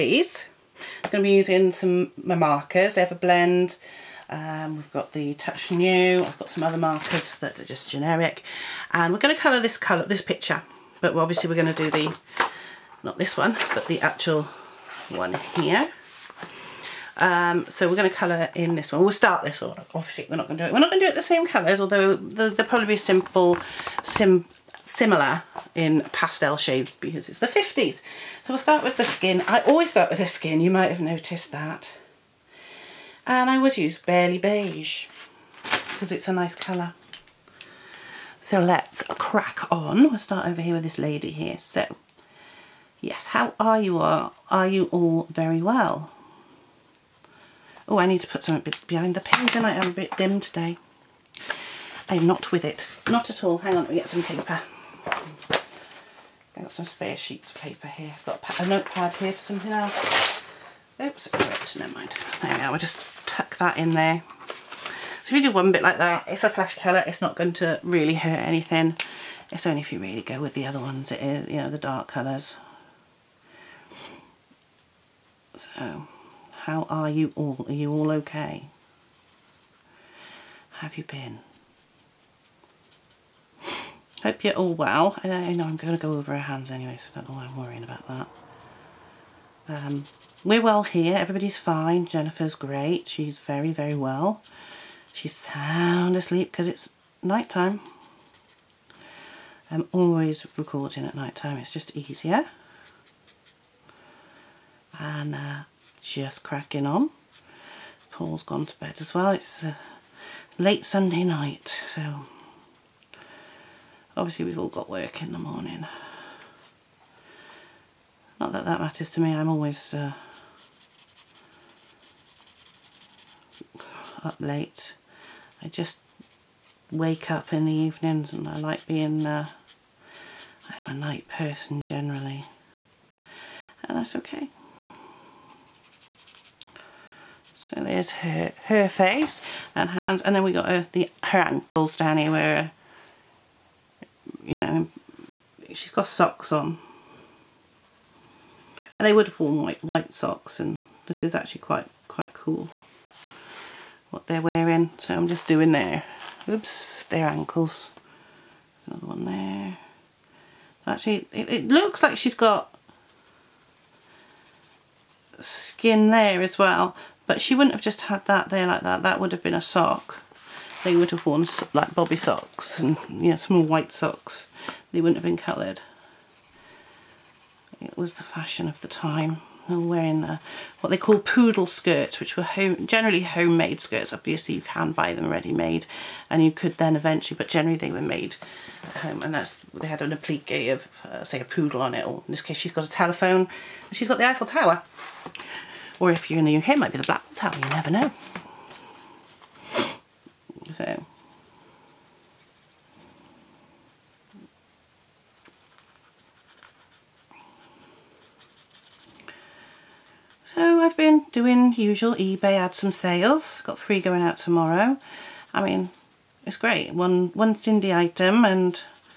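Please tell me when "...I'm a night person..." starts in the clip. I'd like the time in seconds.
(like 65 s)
130 s.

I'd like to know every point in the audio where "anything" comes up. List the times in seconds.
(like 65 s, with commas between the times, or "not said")
68 s.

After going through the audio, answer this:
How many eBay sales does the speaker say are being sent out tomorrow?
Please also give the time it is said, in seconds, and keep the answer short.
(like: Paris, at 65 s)
3, at 213 s.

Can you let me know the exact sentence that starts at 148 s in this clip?
And they would have worn white, white socks and this is actually quite, quite cool what they're wearing.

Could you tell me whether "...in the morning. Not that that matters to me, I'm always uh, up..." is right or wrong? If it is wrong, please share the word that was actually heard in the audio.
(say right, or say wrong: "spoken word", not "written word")
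right.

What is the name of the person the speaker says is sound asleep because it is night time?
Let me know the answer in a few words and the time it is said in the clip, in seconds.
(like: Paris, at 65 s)
Jennifer, at 92 s.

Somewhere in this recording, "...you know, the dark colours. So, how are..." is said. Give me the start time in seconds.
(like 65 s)
71 s.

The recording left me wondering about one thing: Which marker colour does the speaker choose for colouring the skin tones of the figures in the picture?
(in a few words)
Barely Beige.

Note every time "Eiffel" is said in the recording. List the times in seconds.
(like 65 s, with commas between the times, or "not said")
194 s.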